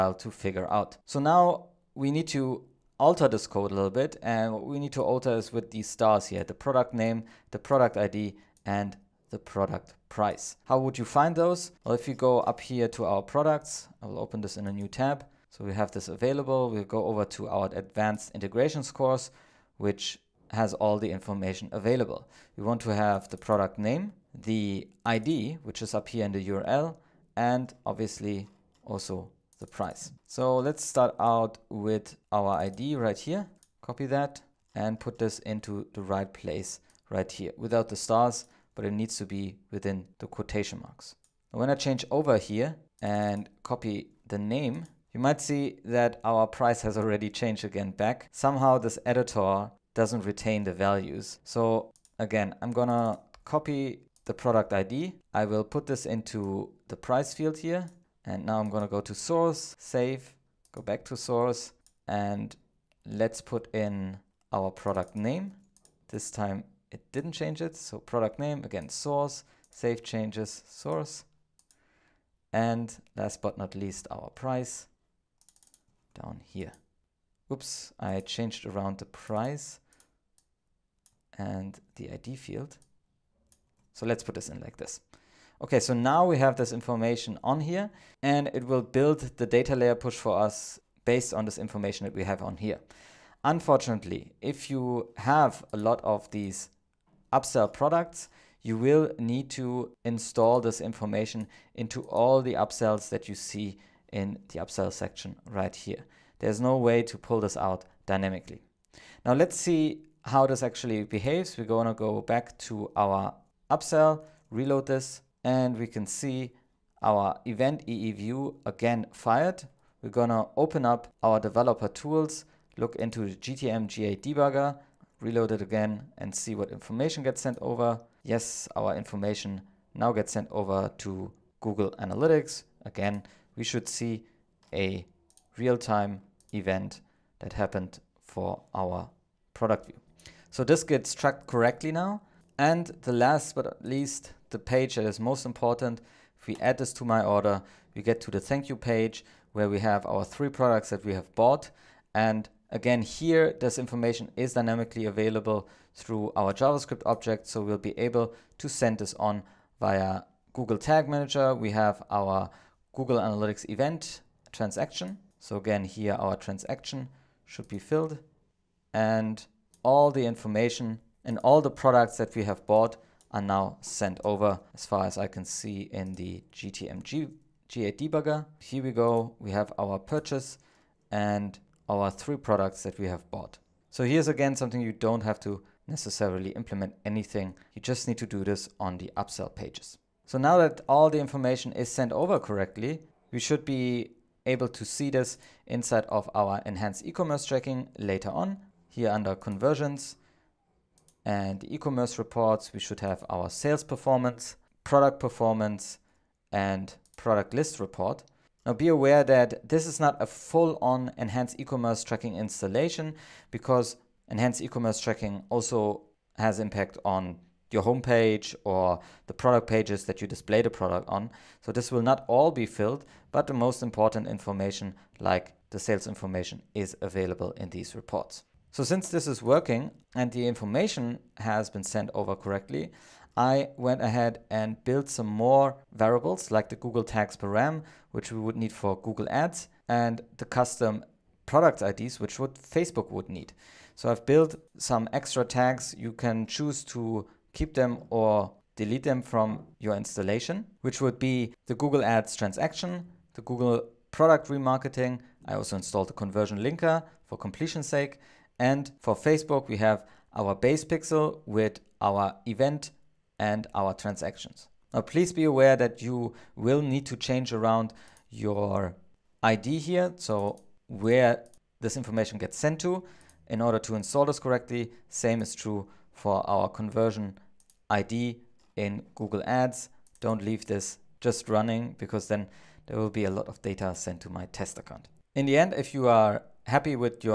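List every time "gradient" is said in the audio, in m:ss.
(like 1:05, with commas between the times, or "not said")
not said.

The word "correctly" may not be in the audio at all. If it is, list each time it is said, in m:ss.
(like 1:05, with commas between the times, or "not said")
2:21, 3:12, 3:52, 4:34.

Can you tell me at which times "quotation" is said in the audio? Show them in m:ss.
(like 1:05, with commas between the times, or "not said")
0:40.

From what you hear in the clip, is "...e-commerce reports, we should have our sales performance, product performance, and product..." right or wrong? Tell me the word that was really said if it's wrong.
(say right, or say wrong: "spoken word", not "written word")
right.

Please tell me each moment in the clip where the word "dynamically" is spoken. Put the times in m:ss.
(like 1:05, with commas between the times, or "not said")
1:48, 2:34.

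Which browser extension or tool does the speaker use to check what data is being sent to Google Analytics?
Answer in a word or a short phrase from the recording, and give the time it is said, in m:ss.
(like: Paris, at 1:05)
GTM GA debugger, at 2:03.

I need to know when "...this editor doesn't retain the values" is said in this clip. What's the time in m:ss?
0:48.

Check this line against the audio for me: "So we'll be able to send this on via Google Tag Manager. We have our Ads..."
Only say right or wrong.
wrong.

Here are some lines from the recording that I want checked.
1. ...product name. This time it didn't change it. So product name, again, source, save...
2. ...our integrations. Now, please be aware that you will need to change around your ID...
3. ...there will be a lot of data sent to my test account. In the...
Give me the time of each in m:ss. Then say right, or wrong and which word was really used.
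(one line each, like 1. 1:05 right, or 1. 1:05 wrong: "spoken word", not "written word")
1. 1:04 right
2. 4:23 wrong: "transactions", not "integrations"
3. 4:42 right.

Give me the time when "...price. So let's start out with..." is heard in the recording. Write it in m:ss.
0:29.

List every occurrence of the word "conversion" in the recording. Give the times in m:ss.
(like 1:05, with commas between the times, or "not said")
3:19, 4:16, 4:36.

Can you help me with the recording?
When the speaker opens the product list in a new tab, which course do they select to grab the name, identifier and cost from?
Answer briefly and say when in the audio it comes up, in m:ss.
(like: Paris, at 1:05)
Advanced integrations course, at 0:17.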